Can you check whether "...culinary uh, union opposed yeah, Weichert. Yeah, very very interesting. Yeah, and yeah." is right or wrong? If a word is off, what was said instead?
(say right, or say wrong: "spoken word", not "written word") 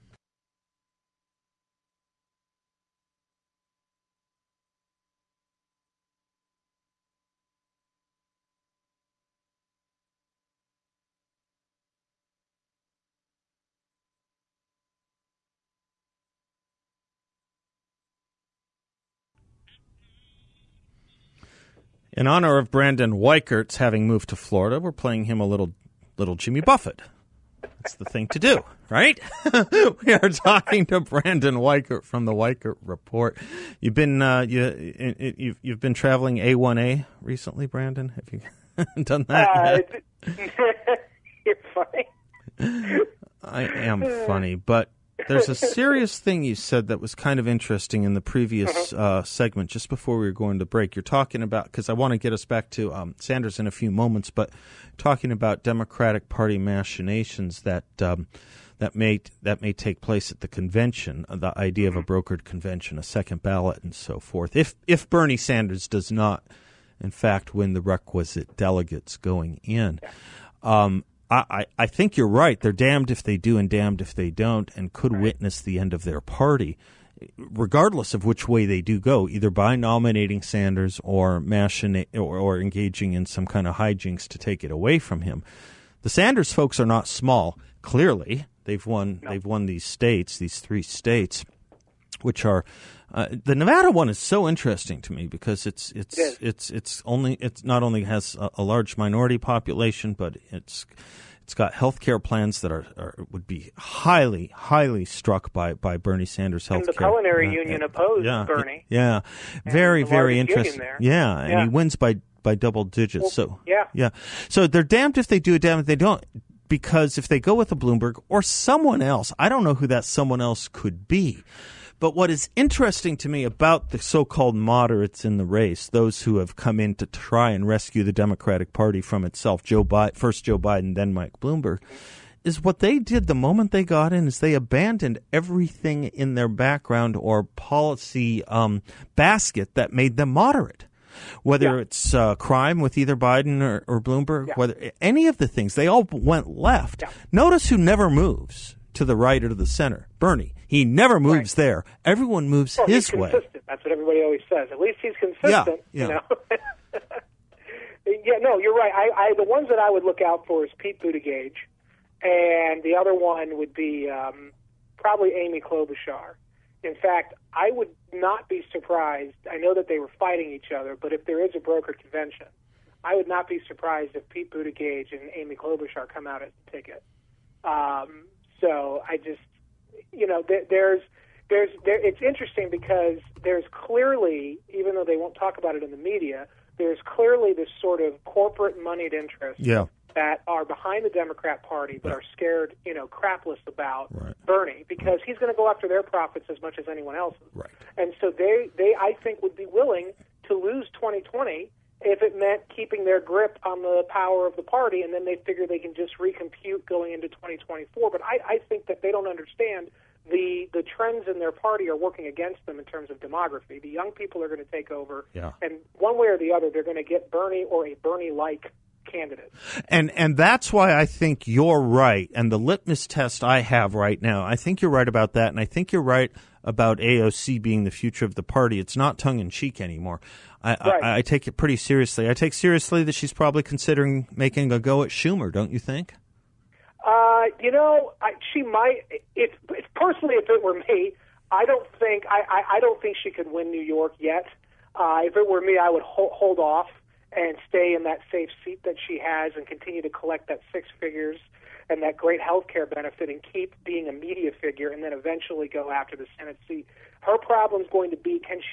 wrong: "Bernie", not "Weichert".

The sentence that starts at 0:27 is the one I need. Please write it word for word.
That's the thing to do, right?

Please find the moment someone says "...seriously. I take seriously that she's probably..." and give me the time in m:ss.
3:51.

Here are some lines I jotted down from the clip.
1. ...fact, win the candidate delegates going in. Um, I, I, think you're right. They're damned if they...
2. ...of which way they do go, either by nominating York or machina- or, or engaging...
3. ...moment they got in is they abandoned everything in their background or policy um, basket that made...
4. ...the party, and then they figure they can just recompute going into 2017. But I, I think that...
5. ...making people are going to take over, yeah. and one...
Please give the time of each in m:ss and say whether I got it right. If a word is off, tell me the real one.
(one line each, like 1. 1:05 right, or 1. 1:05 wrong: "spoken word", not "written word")
1. 1:07 wrong: "requisite", not "candidate"
2. 1:18 wrong: "Sanders", not "York"
3. 2:13 right
4. 3:24 wrong: "2024", not "2017"
5. 3:33 wrong: "young", not "making".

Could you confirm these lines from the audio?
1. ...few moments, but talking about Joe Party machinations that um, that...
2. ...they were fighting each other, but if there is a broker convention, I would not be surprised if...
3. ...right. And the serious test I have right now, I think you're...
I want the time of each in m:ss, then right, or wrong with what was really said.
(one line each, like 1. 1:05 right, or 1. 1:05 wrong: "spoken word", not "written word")
1. 0:53 wrong: "Democratic", not "Joe"
2. 2:49 right
3. 3:41 wrong: "litmus", not "serious".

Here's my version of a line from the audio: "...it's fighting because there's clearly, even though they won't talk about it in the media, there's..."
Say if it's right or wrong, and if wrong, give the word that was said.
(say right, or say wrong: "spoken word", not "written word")
wrong: "interesting", not "fighting".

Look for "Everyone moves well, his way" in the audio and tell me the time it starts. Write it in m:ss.
2:32.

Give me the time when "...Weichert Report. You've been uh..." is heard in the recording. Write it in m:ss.
0:32.